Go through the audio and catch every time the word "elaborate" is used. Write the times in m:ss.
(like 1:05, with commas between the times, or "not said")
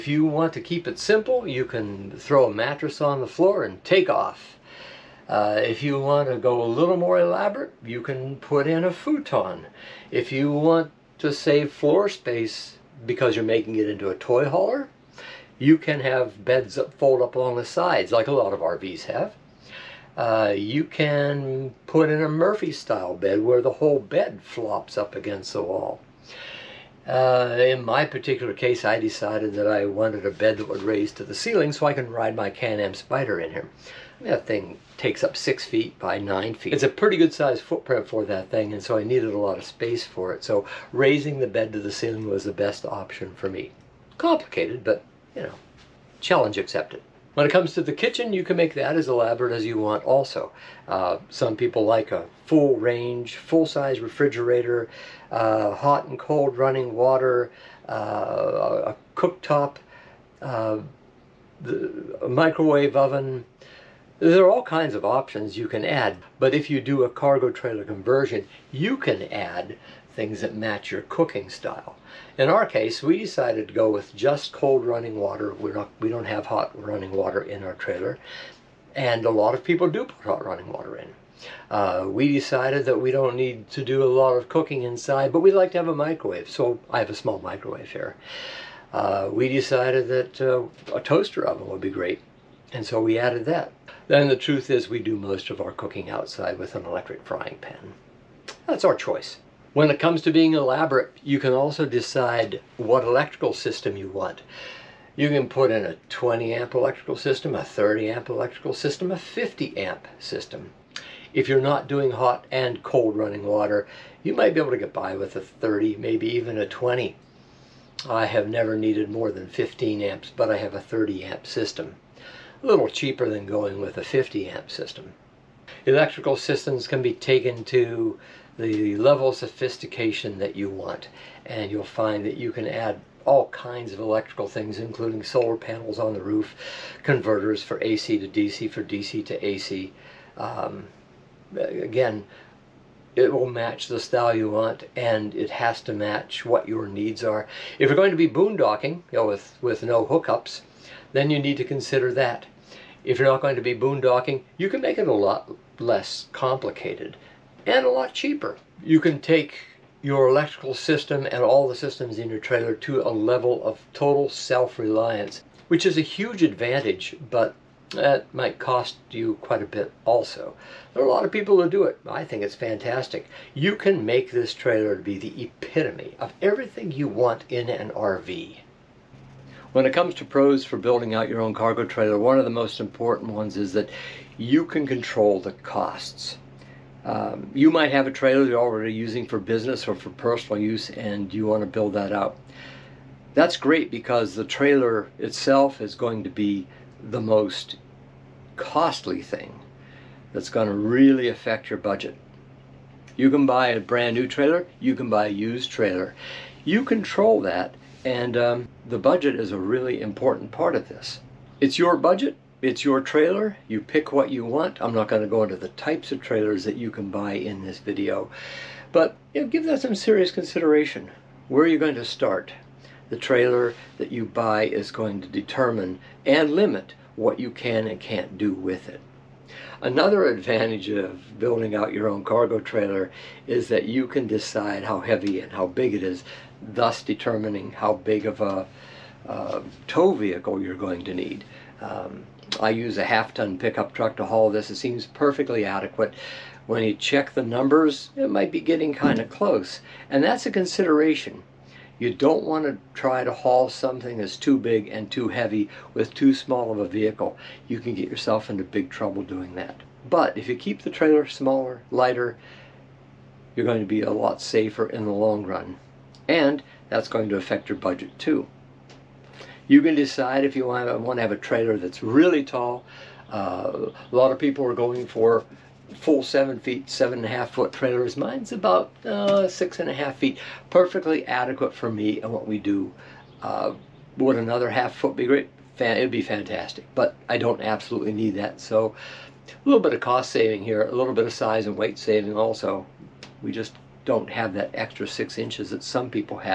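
0:07, 0:49, 1:40.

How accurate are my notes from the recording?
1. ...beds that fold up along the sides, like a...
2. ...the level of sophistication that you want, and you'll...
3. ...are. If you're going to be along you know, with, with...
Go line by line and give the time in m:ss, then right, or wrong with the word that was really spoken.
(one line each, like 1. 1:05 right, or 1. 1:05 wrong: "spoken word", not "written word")
1. 0:16 right
2. 2:08 right
3. 2:27 wrong: "boondocking", not "along".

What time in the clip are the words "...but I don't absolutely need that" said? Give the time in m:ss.
4:46.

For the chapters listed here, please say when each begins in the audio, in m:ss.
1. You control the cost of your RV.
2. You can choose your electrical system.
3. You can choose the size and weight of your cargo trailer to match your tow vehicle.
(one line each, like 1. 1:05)
1. 2:58
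2. 1:41
3. 3:52.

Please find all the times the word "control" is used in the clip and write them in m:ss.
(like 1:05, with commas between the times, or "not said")
3:04, 3:26.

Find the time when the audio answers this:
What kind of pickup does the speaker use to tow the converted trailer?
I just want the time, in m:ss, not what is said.
4:03.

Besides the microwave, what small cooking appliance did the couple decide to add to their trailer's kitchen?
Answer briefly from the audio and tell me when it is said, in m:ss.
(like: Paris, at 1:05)
toaster oven, at 1:30.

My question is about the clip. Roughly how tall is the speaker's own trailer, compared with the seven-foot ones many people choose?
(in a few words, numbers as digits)
6.5 feet.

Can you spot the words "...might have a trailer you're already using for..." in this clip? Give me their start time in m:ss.
3:07.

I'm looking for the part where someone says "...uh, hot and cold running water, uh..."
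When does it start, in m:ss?
0:55.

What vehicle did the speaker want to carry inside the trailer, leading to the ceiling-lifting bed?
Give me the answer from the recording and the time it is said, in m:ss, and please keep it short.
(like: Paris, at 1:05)
Can-Am Spyder, at 0:32.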